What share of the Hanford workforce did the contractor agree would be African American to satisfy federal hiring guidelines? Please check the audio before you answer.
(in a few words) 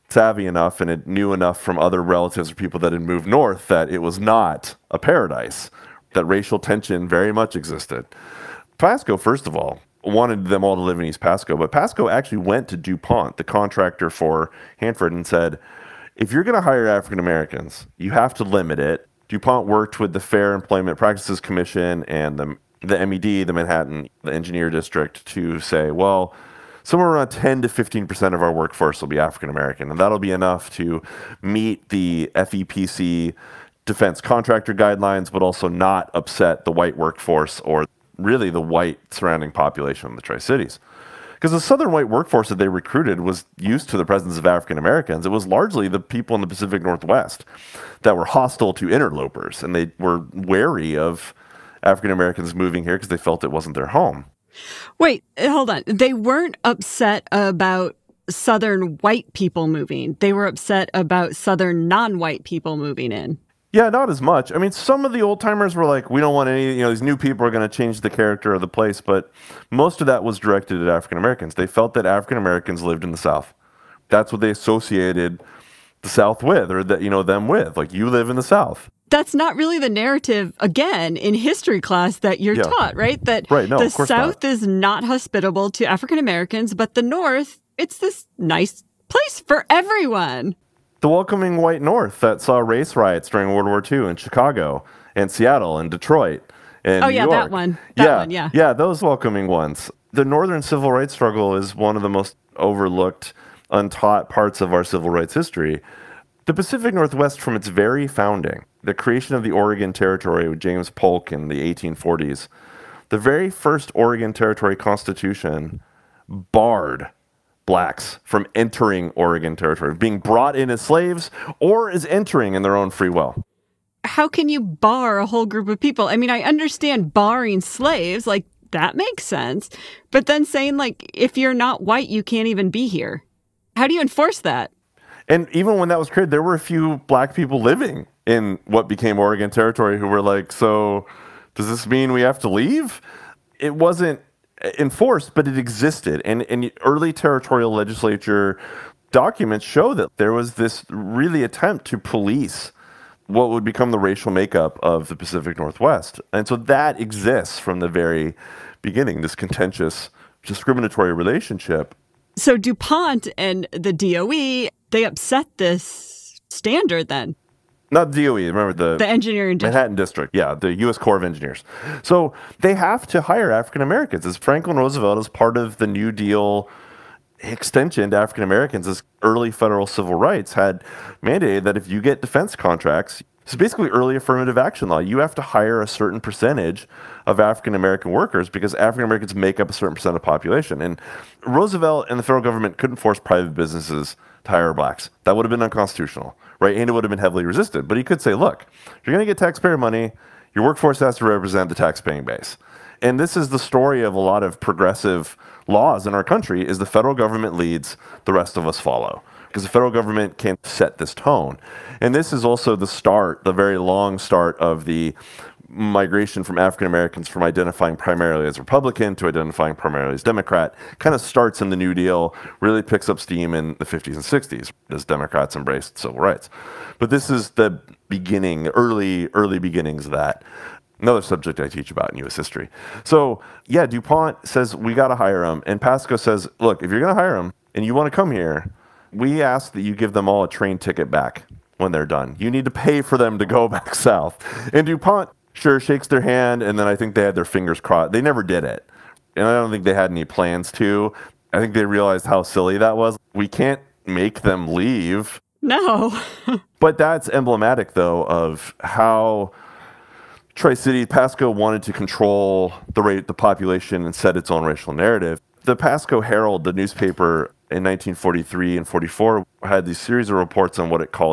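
10 to 15%.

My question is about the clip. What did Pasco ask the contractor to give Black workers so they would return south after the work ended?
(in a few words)
A train ticket.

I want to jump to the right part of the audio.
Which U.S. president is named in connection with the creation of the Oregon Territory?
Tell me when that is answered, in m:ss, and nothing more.
1:50.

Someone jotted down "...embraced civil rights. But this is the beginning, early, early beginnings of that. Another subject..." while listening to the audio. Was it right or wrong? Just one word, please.
right.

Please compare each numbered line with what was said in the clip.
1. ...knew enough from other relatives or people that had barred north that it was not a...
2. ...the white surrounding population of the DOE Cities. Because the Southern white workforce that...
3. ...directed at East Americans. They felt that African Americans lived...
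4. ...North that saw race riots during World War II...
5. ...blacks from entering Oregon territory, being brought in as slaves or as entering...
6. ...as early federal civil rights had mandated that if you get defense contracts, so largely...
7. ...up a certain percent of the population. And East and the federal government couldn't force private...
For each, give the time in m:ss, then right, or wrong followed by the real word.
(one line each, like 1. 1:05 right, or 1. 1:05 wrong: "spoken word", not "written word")
1. 0:01 wrong: "moved", not "barred"
2. 0:38 wrong: "Tri", not "DOE"
3. 1:10 wrong: "African", not "East"
4. 1:31 right
5. 1:57 right
6. 2:58 wrong: "basically", not "largely"
7. 3:09 wrong: "Roosevelt", not "East".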